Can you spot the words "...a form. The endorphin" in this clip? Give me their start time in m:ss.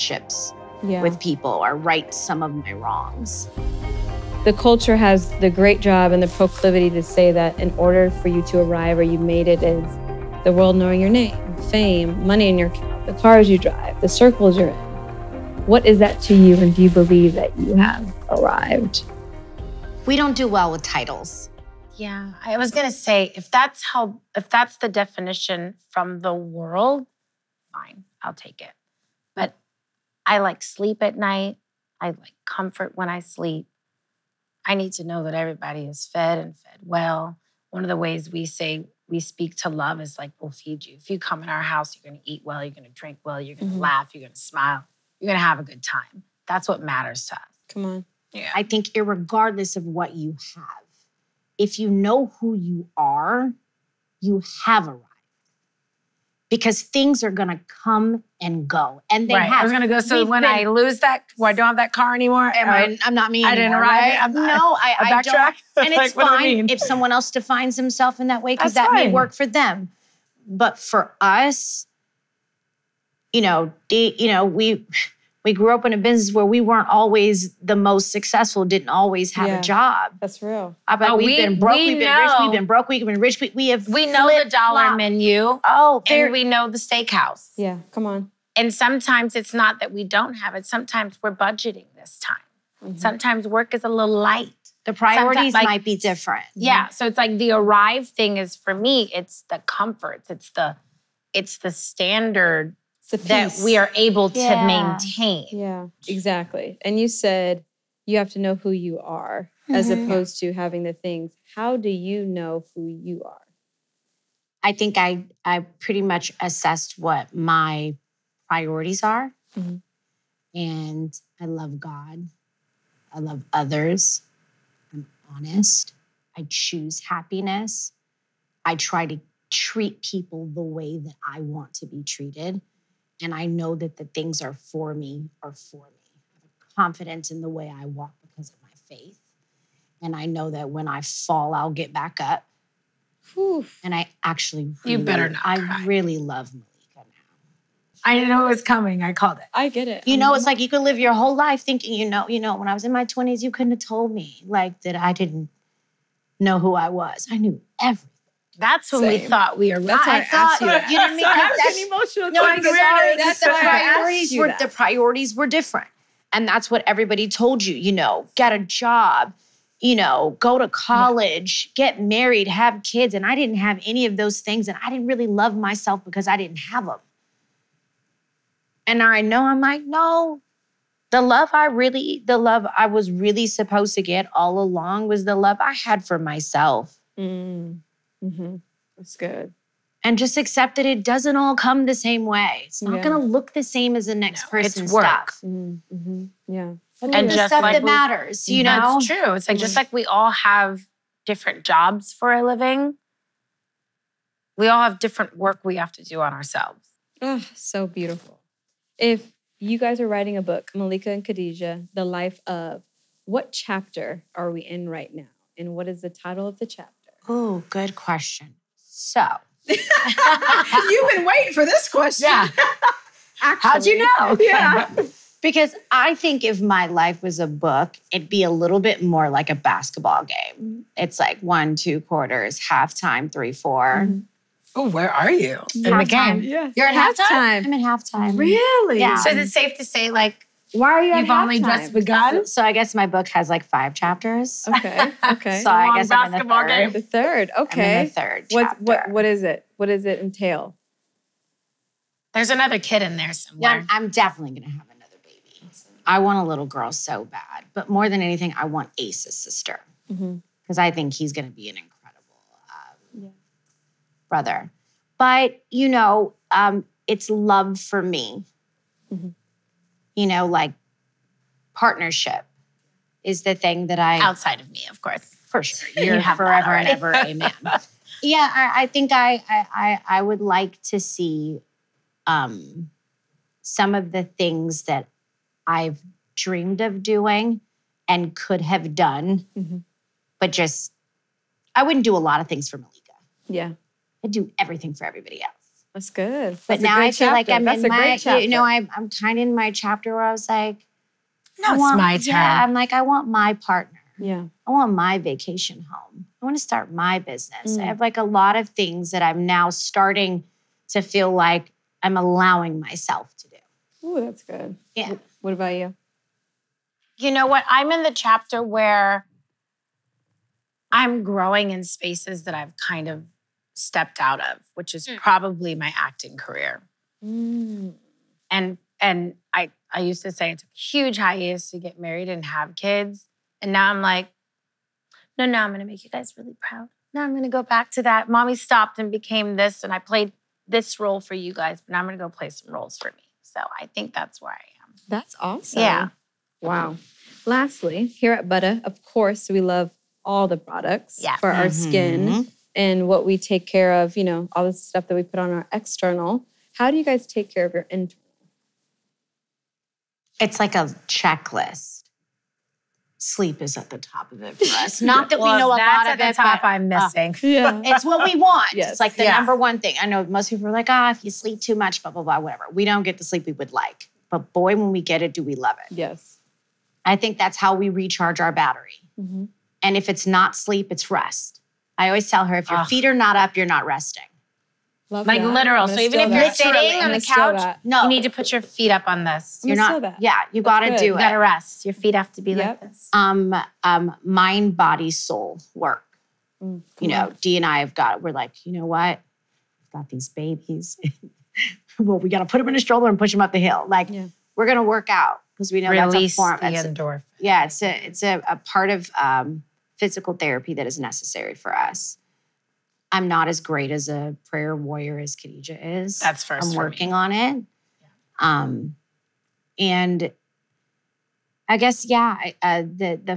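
6:46.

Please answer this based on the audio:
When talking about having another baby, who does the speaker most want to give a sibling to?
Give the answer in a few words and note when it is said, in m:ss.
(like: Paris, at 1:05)
Ace, at 4:18.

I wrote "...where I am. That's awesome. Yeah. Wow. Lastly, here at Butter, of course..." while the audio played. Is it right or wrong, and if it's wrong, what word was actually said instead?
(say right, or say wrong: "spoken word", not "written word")
right.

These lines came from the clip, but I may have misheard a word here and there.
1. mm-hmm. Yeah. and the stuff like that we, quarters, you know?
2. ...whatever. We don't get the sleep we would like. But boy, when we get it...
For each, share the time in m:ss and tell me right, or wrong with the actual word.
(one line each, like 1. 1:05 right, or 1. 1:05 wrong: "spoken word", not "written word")
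1. 3:15 wrong: "matters", not "quarters"
2. 6:12 right.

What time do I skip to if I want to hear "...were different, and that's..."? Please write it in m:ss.
2:45.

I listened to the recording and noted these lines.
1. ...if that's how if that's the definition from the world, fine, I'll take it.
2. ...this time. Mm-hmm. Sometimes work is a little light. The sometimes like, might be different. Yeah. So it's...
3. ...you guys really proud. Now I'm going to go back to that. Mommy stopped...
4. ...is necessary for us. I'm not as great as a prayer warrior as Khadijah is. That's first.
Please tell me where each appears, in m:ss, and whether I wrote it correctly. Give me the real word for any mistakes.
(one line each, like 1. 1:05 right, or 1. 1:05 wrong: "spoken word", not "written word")
1. 0:23 right
2. 1:31 wrong: "priorities", not "sometimes"
3. 5:36 right
4. 6:50 right.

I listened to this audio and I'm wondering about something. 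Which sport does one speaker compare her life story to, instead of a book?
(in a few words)
basketball.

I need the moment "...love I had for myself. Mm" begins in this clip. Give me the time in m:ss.
3:05.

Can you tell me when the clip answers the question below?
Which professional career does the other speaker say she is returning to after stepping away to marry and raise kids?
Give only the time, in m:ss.
5:25.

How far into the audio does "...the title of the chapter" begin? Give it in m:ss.
3:36.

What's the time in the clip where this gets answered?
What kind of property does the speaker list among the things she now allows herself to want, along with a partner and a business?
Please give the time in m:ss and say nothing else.
5:05.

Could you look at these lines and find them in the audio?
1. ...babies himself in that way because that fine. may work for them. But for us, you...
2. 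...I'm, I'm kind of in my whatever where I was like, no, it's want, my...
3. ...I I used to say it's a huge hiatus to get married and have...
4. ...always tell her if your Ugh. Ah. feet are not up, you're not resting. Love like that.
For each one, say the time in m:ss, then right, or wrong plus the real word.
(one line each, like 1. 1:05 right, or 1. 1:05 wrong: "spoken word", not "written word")
1. 1:07 wrong: "defines", not "babies"
2. 4:58 wrong: "chapter", not "whatever"
3. 5:29 right
4. 6:22 right.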